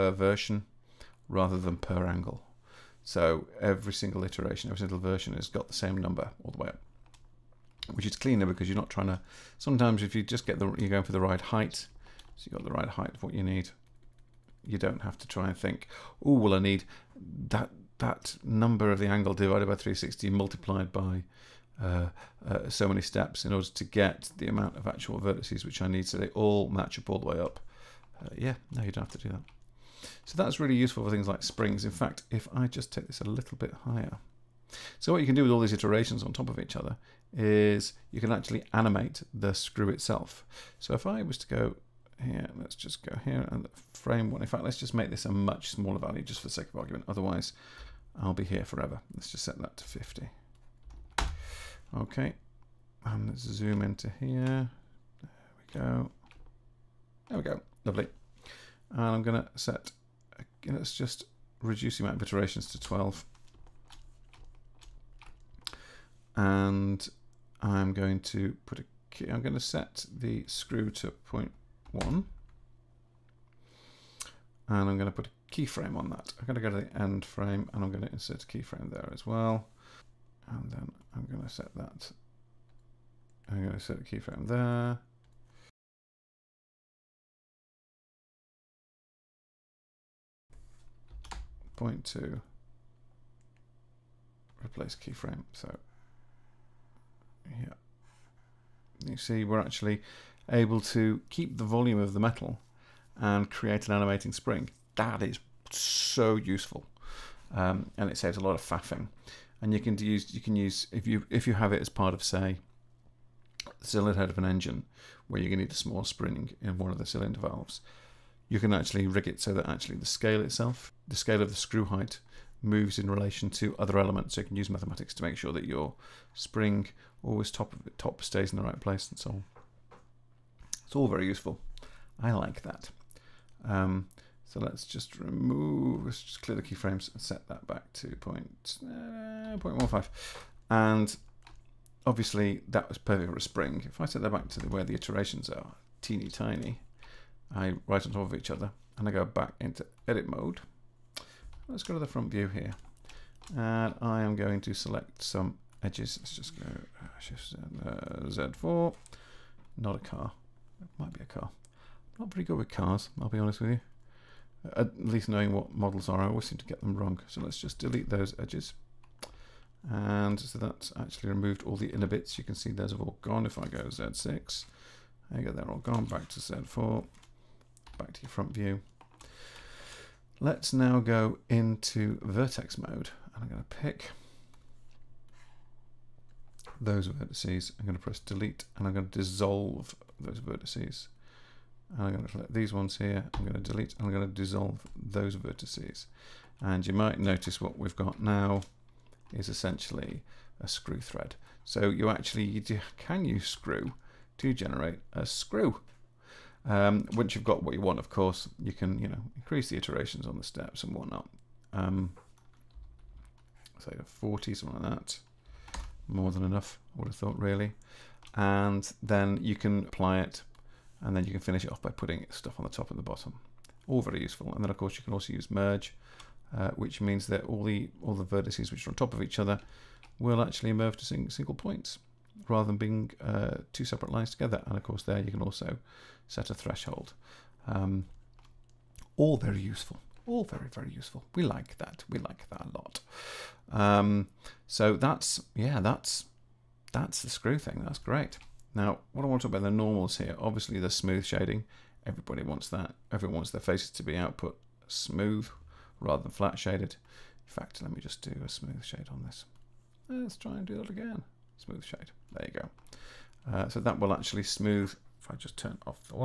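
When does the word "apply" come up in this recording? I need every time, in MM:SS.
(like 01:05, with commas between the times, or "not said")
03:39.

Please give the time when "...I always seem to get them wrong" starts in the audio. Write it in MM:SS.
02:46.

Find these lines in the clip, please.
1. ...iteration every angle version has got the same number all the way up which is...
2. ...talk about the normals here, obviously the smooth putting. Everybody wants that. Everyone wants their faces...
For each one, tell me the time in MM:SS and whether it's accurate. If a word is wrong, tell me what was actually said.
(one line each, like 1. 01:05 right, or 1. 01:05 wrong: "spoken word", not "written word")
1. 00:04 wrong: "single", not "angle"
2. 04:09 wrong: "shading", not "putting".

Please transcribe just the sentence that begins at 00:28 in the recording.
Uh, yeah, no, you don't have to do that.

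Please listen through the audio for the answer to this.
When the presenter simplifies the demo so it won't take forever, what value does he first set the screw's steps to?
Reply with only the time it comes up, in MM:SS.
00:49.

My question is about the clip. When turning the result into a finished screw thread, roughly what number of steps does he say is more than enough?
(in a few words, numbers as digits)
40.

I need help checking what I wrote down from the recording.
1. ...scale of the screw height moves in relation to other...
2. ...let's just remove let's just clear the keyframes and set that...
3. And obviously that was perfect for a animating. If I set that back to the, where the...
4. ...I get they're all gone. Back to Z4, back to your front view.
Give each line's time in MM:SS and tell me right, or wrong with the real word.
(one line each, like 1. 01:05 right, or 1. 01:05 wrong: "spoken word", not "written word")
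1. 02:01 right
2. 02:14 right
3. 02:20 wrong: "spring", not "animating"
4. 02:55 right.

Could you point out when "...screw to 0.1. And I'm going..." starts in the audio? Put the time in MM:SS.
01:10.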